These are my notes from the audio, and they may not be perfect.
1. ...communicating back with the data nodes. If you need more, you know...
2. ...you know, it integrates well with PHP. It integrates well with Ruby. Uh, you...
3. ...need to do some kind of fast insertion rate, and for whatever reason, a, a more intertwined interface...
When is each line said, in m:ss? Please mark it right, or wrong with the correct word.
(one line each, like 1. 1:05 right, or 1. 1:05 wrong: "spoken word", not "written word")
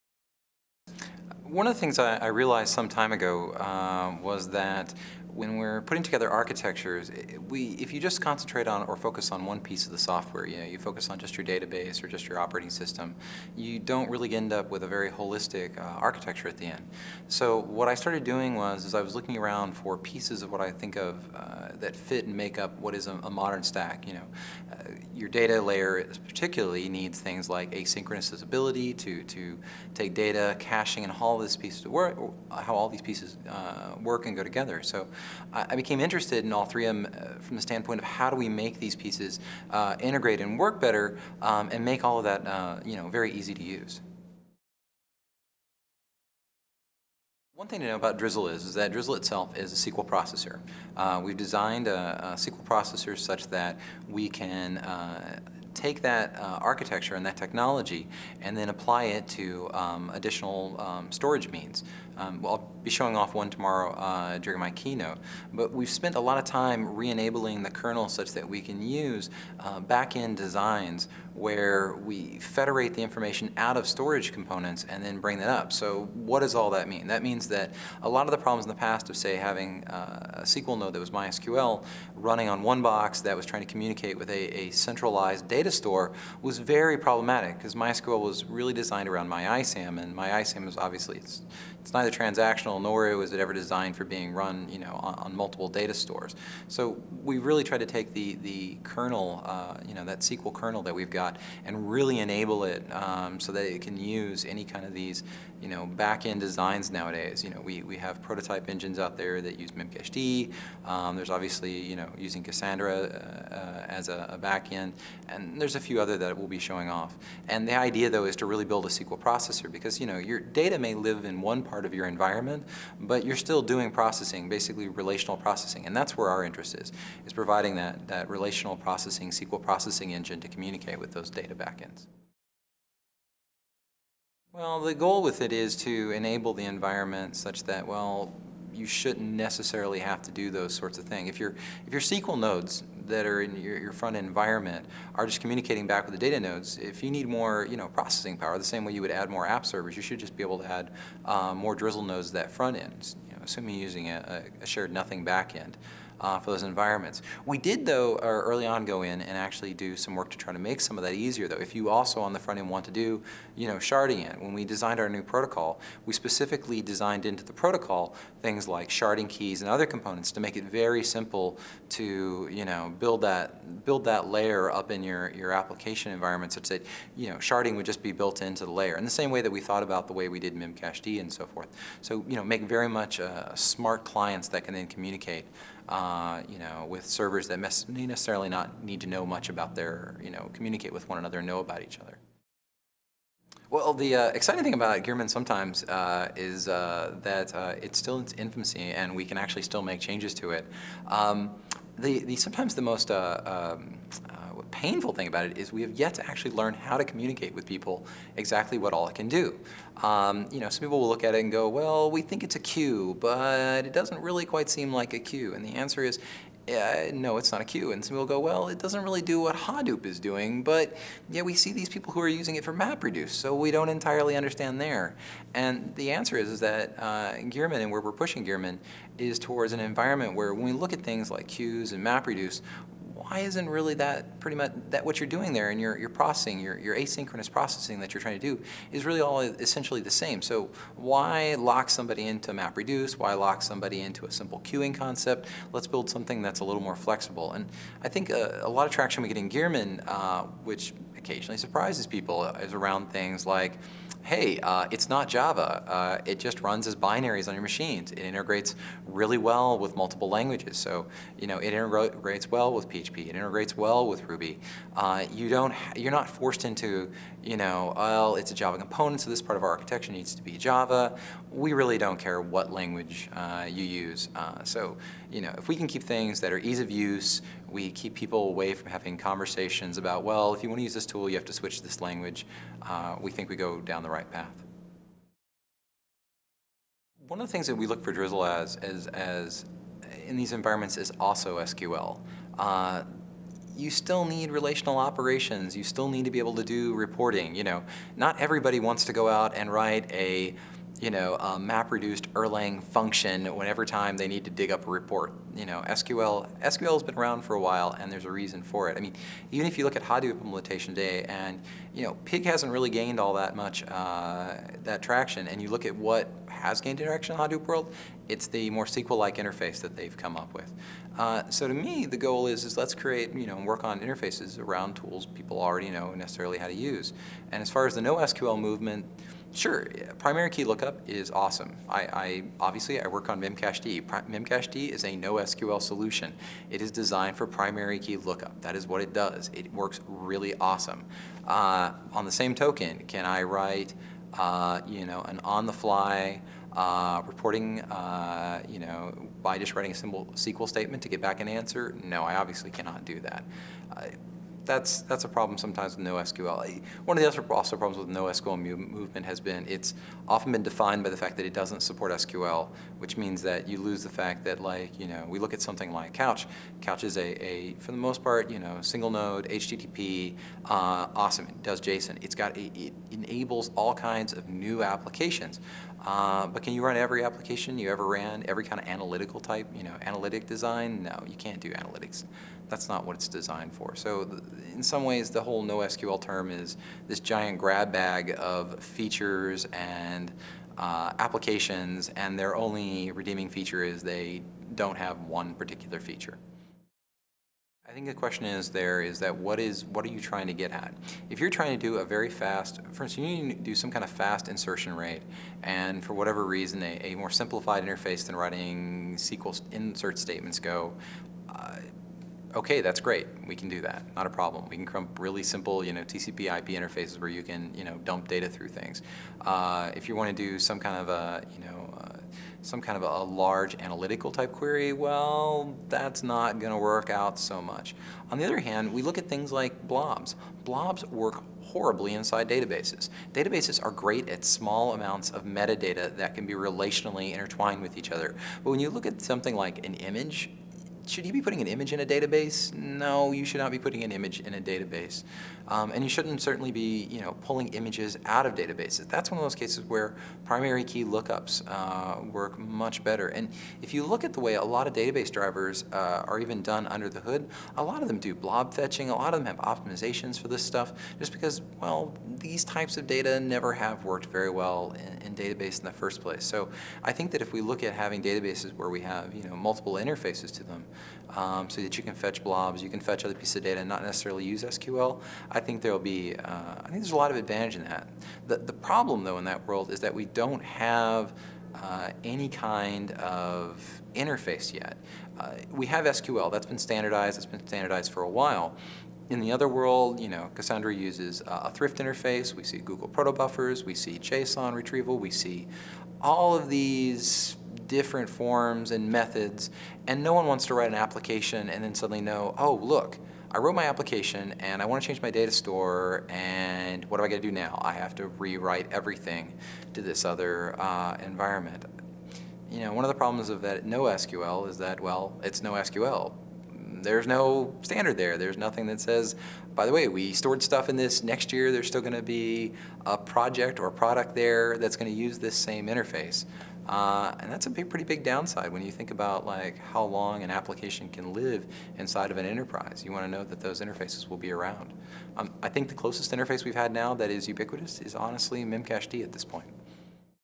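1. 2:25 right
2. 4:21 right
3. 6:43 wrong: "simplified", not "intertwined".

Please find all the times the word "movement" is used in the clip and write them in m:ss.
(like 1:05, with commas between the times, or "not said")
5:28, 5:58.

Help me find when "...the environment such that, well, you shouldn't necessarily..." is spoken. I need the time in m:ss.
2:16.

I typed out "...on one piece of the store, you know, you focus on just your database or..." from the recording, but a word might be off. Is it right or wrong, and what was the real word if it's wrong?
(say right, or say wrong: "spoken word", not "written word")
wrong: "software", not "store".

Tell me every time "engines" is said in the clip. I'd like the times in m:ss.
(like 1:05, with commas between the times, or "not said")
1:48, 2:10.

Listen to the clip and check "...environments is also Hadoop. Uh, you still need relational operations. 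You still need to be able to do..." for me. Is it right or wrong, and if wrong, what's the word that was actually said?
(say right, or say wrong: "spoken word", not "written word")
wrong: "SQL", not "Hadoop".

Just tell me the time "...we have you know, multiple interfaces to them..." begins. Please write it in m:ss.
7:48.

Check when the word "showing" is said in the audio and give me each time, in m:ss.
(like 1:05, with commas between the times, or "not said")
1:02, 1:56.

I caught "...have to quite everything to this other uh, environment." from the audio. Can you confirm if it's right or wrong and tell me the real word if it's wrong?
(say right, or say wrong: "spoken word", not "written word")
wrong: "rewrite", not "quite".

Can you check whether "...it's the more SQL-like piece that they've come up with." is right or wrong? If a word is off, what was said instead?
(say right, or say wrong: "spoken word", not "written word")
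wrong: "interface", not "piece".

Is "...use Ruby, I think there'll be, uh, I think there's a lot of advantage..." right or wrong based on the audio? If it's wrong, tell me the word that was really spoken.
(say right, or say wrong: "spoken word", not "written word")
wrong: "SQL", not "Ruby".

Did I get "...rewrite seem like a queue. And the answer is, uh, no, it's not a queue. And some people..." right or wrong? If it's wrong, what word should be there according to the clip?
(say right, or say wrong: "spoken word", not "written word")
wrong: "quite", not "rewrite".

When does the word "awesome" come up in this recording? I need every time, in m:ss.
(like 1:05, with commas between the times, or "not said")
5:31, 5:40, 6:11.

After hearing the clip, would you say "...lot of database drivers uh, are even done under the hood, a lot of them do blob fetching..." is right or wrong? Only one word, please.
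right.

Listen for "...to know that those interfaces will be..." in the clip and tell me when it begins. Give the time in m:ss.
8:53.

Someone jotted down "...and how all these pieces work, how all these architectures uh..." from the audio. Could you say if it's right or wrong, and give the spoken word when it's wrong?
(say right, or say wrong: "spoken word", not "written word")
wrong: "pieces", not "architectures".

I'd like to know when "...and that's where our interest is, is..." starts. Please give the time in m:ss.
2:05.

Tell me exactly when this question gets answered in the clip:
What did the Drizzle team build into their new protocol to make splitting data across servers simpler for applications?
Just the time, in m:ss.
2:48.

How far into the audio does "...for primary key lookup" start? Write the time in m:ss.
5:37.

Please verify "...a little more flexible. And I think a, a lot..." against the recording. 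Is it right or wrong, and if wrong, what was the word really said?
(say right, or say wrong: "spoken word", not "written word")
right.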